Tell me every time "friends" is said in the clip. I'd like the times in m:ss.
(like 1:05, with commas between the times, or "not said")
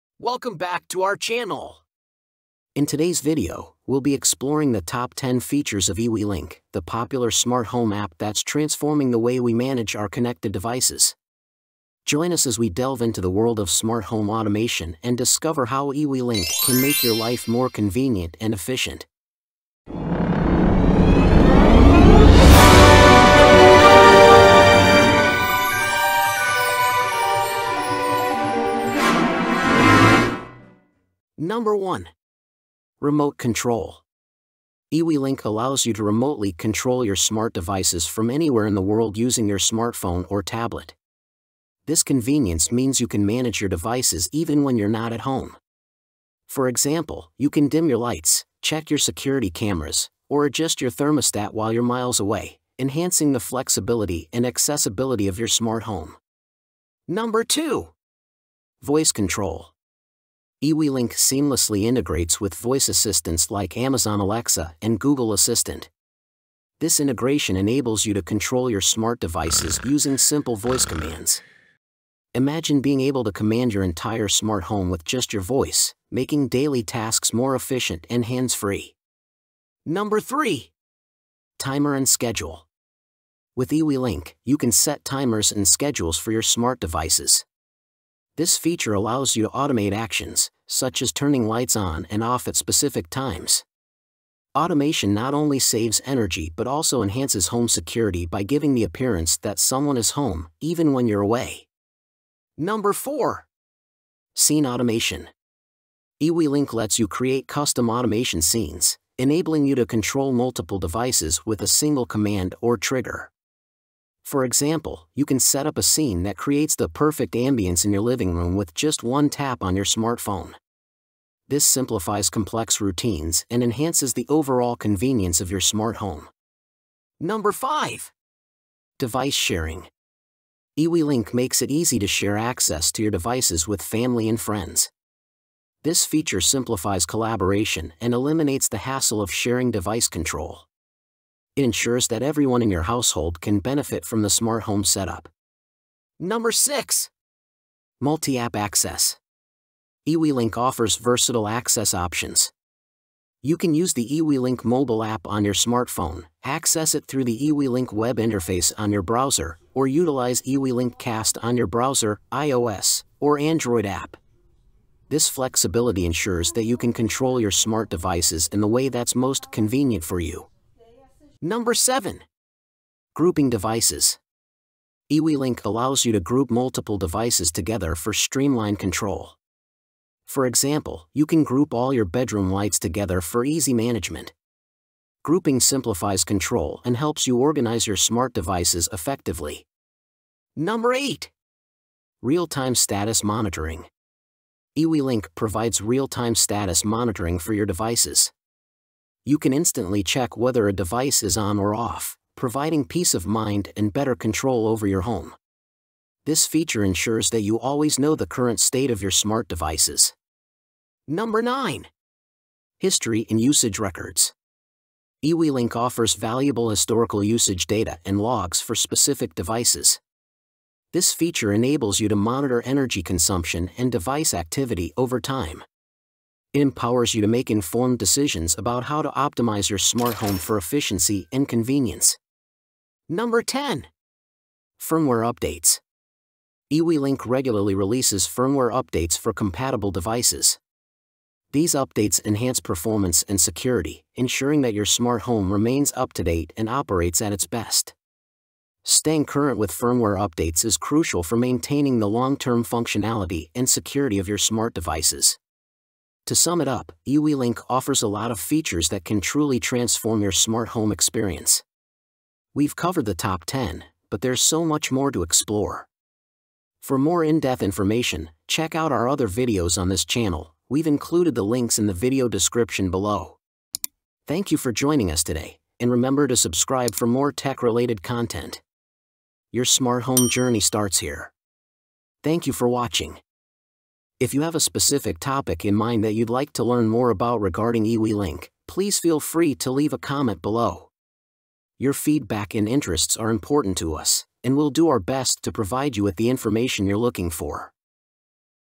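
2:14.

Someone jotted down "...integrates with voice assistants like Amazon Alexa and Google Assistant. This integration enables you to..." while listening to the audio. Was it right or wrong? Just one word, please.
right.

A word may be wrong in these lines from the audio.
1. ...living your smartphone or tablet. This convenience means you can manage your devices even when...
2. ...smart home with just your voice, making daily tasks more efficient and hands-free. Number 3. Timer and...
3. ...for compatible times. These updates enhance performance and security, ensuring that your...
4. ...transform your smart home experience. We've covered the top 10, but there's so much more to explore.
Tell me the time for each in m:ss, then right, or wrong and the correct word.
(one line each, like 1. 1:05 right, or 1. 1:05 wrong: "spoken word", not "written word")
1. 0:39 wrong: "using", not "living"
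2. 1:14 right
3. 3:59 wrong: "devices", not "times"
4. 4:19 right.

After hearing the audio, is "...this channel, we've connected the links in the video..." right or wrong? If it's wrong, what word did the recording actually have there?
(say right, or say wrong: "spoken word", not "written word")
wrong: "included", not "connected".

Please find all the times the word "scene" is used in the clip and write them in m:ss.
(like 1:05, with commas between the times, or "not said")
1:44, 1:48, 1:55.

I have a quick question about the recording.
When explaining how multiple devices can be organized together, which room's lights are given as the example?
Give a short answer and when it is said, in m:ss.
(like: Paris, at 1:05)
bedroom, at 3:02.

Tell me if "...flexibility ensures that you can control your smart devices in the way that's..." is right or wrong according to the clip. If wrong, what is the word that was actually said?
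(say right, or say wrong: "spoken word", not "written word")
right.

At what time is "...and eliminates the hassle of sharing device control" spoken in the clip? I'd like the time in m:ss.
2:17.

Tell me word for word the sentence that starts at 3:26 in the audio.
This feature ensures that you always know the current state of your smart devices.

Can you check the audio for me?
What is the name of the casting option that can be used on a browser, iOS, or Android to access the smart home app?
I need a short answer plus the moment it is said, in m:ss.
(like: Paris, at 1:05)
eWeLink Cast, at 2:40.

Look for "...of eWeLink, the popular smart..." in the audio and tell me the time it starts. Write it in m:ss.
0:05.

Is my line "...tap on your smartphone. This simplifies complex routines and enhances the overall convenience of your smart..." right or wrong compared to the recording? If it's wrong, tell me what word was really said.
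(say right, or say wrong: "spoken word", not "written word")
right.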